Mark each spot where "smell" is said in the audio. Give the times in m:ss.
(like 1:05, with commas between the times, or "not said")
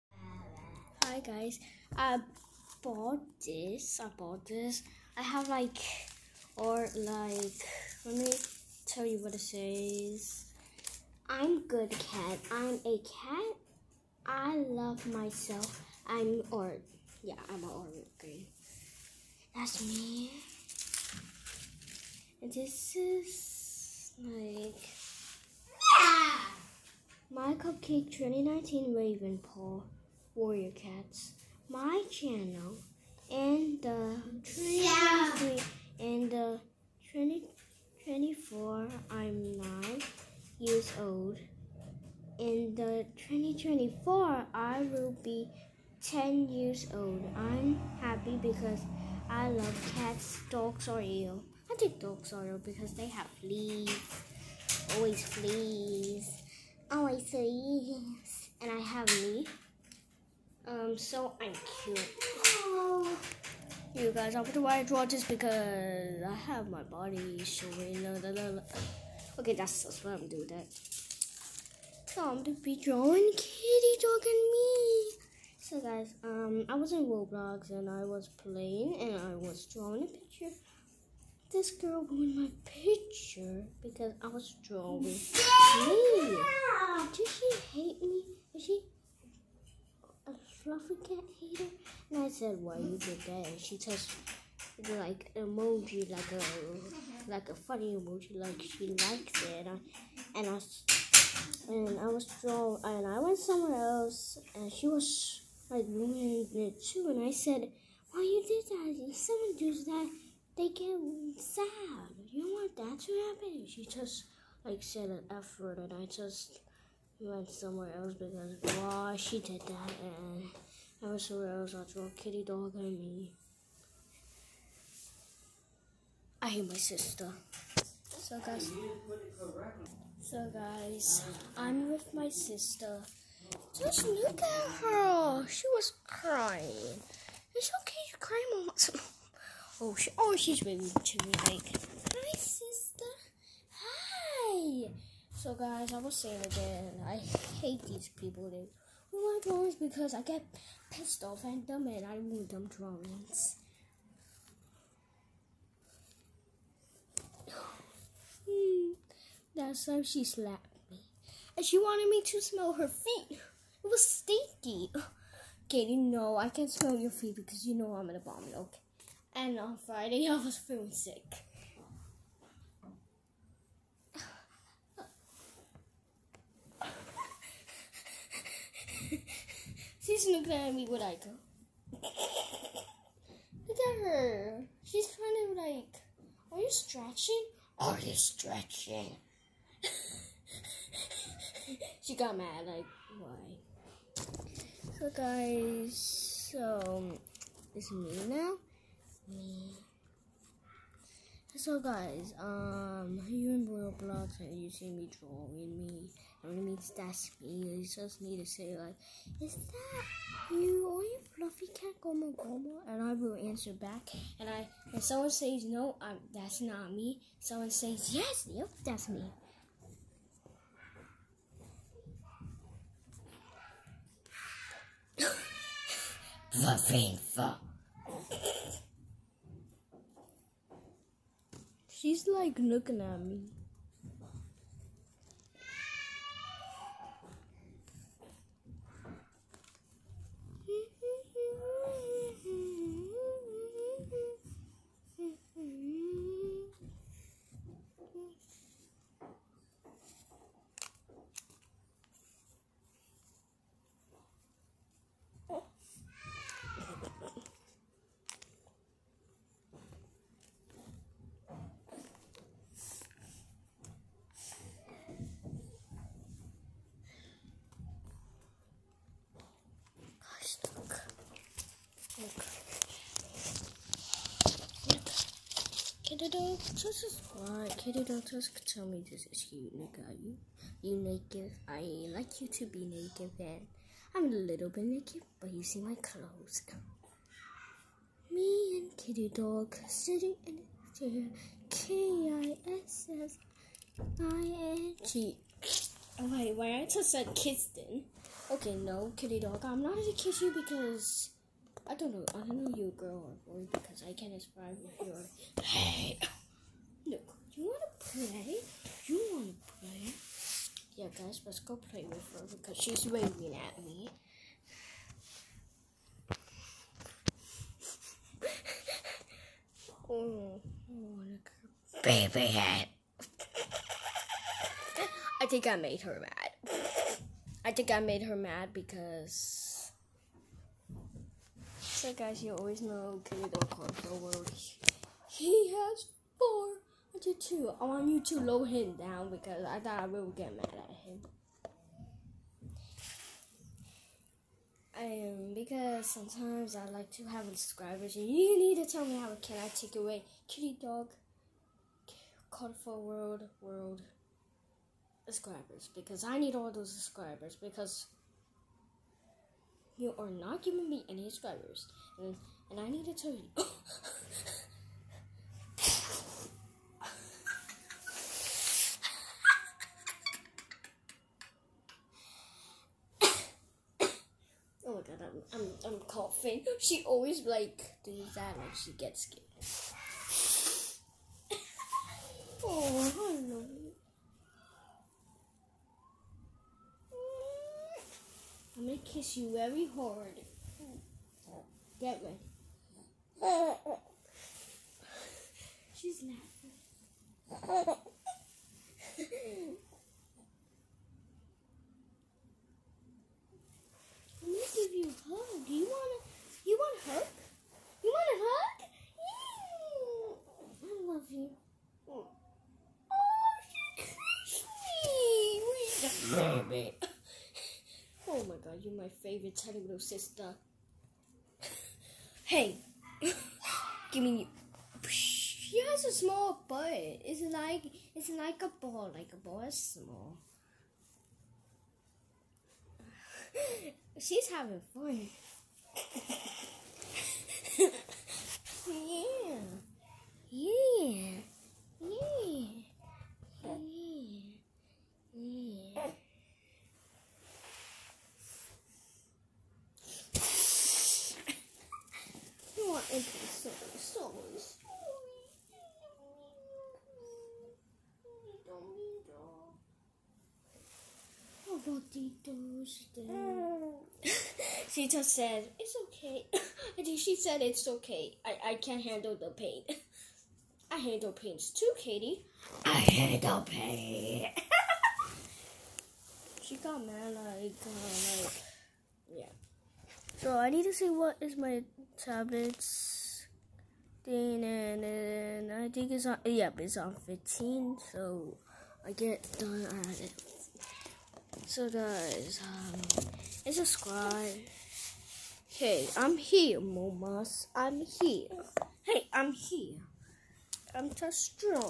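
2:42, 2:46.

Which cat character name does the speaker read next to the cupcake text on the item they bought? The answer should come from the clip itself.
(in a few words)
Raven Paw.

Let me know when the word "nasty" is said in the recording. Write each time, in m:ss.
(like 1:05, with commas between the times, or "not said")
not said.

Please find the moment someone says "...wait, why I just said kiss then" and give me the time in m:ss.
4:56.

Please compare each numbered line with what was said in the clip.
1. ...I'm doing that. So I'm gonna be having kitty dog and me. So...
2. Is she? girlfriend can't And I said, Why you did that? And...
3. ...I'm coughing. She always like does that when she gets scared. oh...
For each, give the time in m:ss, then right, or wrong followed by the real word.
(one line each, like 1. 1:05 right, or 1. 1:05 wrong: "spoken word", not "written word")
1. 1:10 wrong: "drawing", not "having"
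2. 1:28 right
3. 6:15 right.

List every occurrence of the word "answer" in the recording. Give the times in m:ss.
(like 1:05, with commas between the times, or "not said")
3:33.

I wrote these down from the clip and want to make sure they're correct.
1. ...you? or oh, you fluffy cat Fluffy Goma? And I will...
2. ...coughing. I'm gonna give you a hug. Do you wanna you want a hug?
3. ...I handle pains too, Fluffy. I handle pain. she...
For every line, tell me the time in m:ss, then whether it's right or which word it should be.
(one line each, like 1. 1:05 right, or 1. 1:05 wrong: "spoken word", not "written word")
1. 3:30 wrong: "Goma", not "Fluffy"
2. 6:36 wrong: "laughing", not "coughing"
3. 7:50 wrong: "Katie", not "Fluffy".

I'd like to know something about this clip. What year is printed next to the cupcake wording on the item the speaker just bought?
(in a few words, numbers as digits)
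2019.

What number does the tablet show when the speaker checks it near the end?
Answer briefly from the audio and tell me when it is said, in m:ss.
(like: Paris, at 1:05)
15, at 8:07.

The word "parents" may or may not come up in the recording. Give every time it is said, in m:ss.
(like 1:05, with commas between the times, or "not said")
not said.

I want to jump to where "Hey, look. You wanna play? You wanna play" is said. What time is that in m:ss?
5:05.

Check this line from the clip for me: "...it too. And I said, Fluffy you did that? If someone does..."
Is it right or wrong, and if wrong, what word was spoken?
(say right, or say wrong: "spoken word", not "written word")
wrong: "Why", not "Fluffy".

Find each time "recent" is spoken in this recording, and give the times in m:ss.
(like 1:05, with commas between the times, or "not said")
not said.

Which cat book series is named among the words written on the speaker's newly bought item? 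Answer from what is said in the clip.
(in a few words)
Warrior Cats.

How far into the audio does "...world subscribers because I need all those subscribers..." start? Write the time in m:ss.
5:53.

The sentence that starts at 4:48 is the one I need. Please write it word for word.
Me and kitty dog sitting in the chair.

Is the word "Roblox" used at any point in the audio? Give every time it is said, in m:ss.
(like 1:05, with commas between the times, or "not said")
1:17, 3:23.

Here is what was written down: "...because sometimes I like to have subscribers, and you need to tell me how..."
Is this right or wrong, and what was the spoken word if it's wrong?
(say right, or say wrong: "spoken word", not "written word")
right.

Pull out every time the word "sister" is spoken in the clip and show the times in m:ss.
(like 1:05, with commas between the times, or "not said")
2:06, 2:12, 2:22, 6:59.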